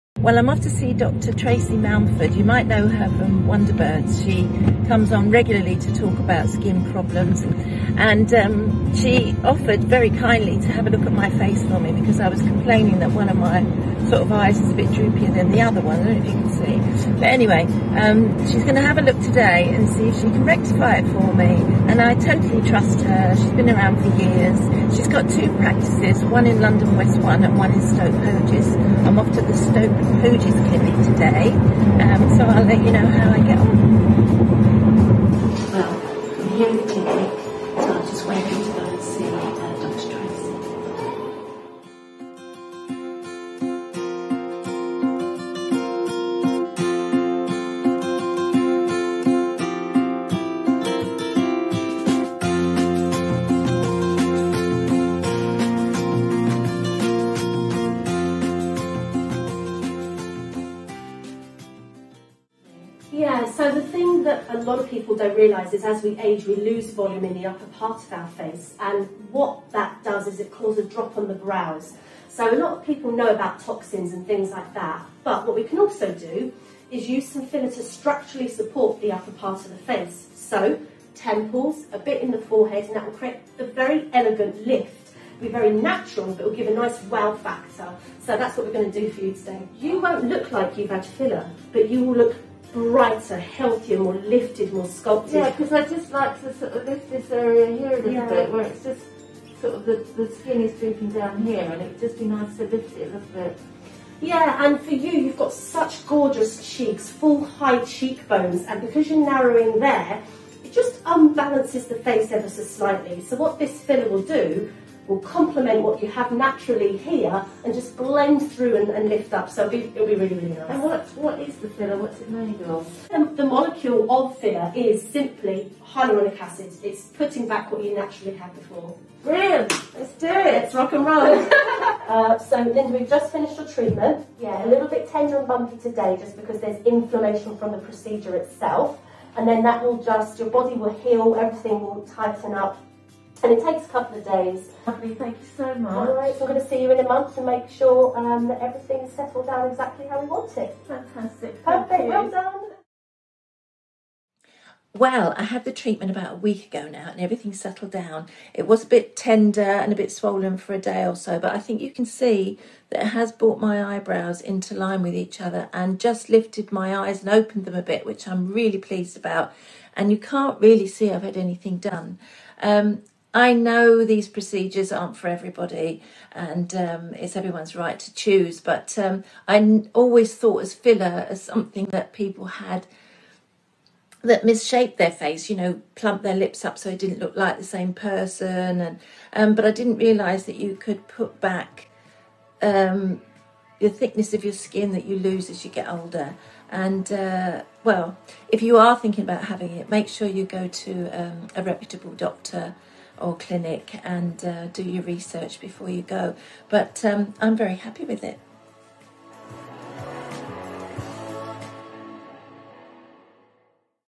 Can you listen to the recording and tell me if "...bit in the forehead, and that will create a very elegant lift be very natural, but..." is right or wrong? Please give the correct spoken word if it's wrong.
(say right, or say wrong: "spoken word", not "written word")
right.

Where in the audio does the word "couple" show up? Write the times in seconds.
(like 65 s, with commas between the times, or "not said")
143 s.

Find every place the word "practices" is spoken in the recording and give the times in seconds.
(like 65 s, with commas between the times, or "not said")
25 s.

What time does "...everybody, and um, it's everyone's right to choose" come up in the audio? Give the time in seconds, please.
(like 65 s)
175 s.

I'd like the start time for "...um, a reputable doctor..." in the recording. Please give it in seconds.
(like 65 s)
201 s.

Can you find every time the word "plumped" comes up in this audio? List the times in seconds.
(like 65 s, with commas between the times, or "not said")
185 s.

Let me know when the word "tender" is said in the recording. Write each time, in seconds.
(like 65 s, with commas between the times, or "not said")
135 s, 159 s.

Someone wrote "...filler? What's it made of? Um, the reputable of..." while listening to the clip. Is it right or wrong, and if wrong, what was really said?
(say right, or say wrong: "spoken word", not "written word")
wrong: "molecule", not "reputable".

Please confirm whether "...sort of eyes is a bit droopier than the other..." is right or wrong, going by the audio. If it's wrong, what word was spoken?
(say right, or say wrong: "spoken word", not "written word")
right.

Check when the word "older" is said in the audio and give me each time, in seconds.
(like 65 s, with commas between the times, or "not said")
195 s.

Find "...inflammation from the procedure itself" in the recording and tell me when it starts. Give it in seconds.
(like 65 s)
136 s.